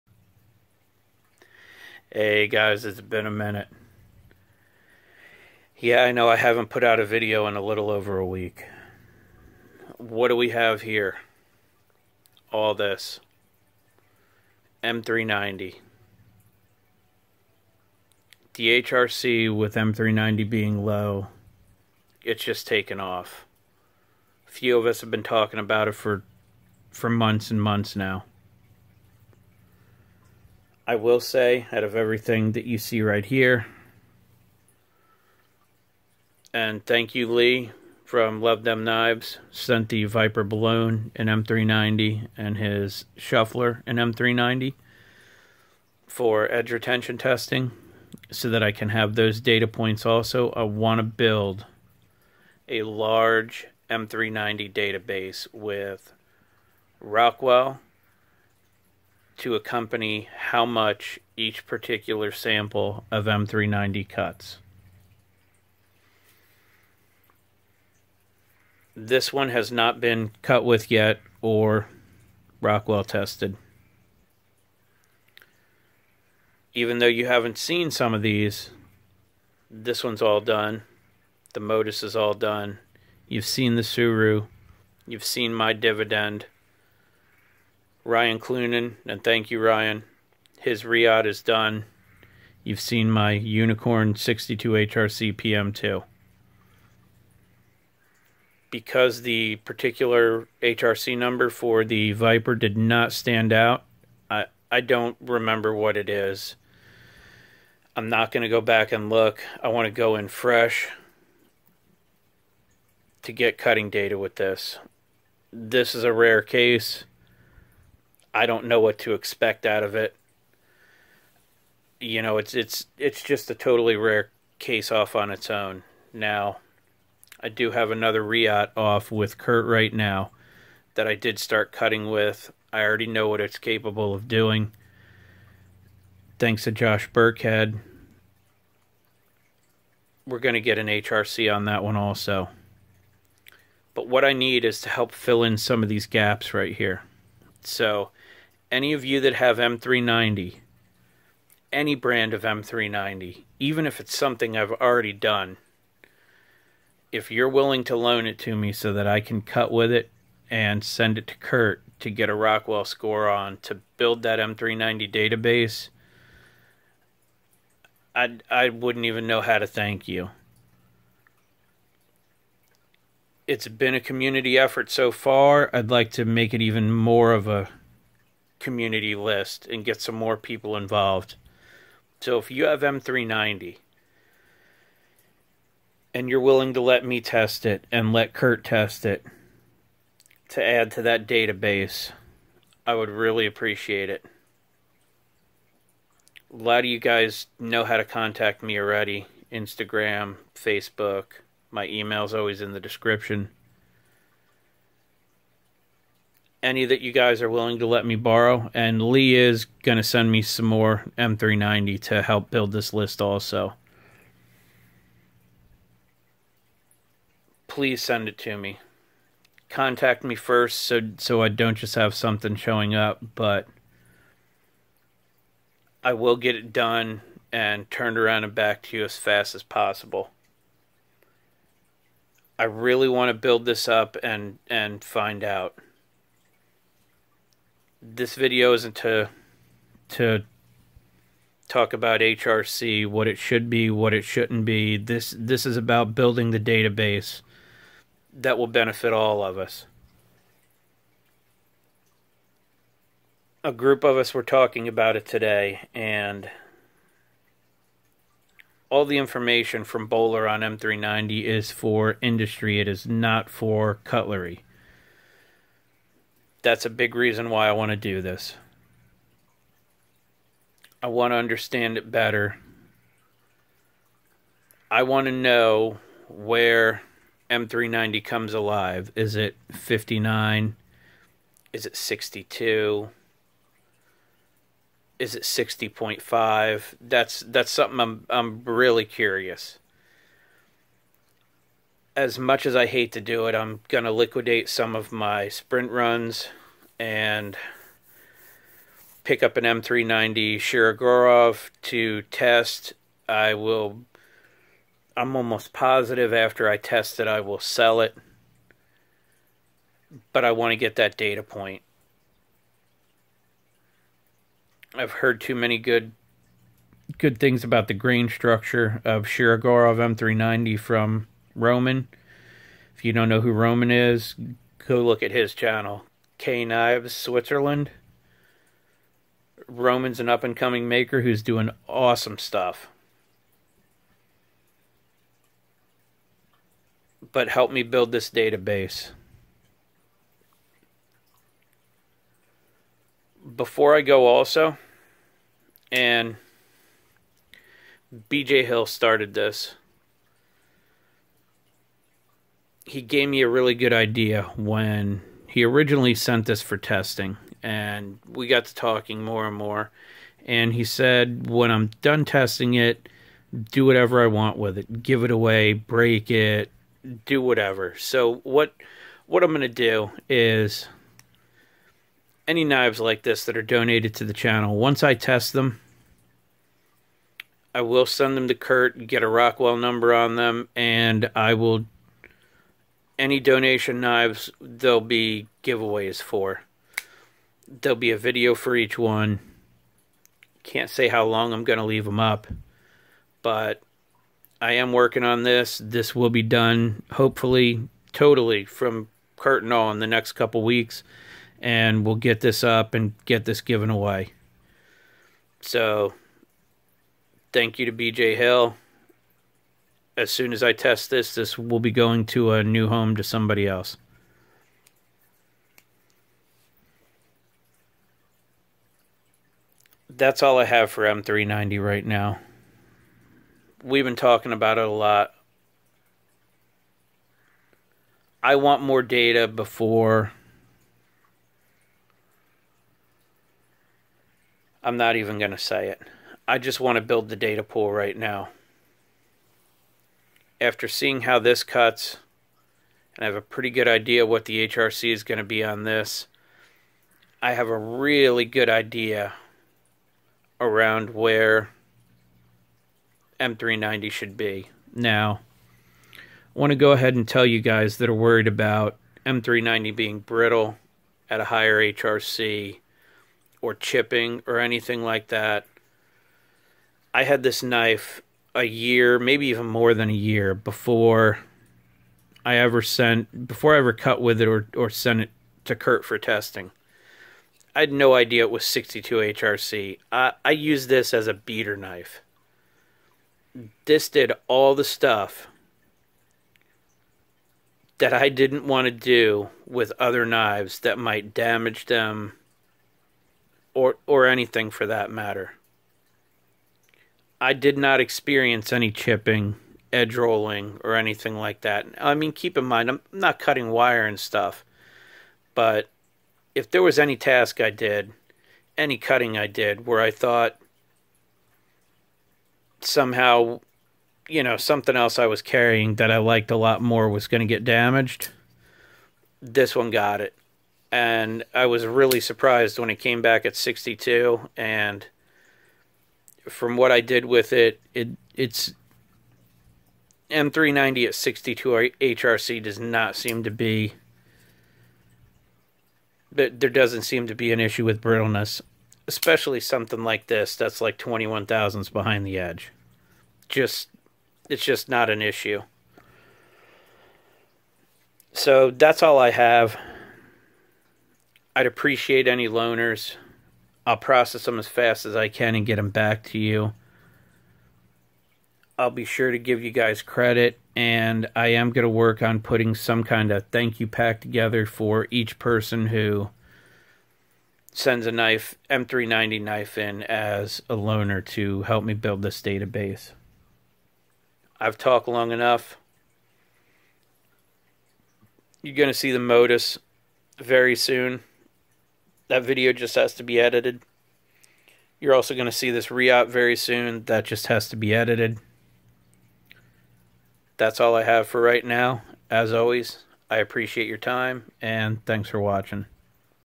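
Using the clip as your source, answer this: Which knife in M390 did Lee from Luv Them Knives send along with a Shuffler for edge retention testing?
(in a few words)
Viper Belone.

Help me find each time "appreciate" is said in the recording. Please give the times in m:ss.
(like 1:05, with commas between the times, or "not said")
3:13, 9:11, 9:53.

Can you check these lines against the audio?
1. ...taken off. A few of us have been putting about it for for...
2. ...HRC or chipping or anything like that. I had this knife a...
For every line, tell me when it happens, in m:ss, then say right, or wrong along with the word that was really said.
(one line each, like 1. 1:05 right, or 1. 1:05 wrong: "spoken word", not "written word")
1. 0:22 wrong: "talking", not "putting"
2. 7:41 right.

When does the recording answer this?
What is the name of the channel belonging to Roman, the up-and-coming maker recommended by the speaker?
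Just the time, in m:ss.
5:26.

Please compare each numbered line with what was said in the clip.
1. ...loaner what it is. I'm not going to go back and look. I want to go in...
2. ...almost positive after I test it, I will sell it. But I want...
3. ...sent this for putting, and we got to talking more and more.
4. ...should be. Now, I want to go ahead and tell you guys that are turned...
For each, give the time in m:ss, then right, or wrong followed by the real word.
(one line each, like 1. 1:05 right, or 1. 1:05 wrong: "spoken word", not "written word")
1. 1:45 wrong: "remember", not "loaner"
2. 5:05 right
3. 5:56 wrong: "testing", not "putting"
4. 7:34 wrong: "worried", not "turned".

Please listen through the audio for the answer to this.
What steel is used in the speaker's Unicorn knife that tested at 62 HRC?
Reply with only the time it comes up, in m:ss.
1:35.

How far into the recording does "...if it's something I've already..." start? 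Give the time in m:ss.
2:33.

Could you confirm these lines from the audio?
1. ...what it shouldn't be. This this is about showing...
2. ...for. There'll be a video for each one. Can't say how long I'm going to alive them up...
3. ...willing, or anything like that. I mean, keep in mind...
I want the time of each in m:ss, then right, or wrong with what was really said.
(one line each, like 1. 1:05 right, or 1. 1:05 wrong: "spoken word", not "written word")
1. 4:03 wrong: "building", not "showing"
2. 6:26 wrong: "leave", not "alive"
3. 8:20 wrong: "rolling", not "willing".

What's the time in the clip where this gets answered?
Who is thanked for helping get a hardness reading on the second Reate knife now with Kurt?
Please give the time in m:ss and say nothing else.
2:16.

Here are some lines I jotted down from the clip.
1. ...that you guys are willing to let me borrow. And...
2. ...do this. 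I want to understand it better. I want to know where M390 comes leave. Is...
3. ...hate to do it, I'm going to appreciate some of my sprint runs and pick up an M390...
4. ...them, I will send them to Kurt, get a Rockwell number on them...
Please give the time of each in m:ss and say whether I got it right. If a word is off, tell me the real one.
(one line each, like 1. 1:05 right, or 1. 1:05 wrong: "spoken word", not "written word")
1. 3:26 right
2. 4:27 wrong: "alive", not "leave"
3. 4:52 wrong: "liquidate", not "appreciate"
4. 6:15 right.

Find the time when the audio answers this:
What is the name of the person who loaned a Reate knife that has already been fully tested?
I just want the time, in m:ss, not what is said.
1:28.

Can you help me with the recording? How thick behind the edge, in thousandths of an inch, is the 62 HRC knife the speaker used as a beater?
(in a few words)
21 thousandths.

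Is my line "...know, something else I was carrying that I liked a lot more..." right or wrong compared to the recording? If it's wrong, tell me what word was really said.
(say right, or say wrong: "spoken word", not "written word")
right.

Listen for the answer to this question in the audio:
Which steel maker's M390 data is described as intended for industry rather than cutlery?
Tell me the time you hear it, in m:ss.
4:20.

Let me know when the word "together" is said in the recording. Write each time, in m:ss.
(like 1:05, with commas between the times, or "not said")
9:24.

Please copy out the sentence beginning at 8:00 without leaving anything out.
I I used this as a beater knife.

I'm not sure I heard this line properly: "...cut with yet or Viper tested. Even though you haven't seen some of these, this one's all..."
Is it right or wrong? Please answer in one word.
wrong.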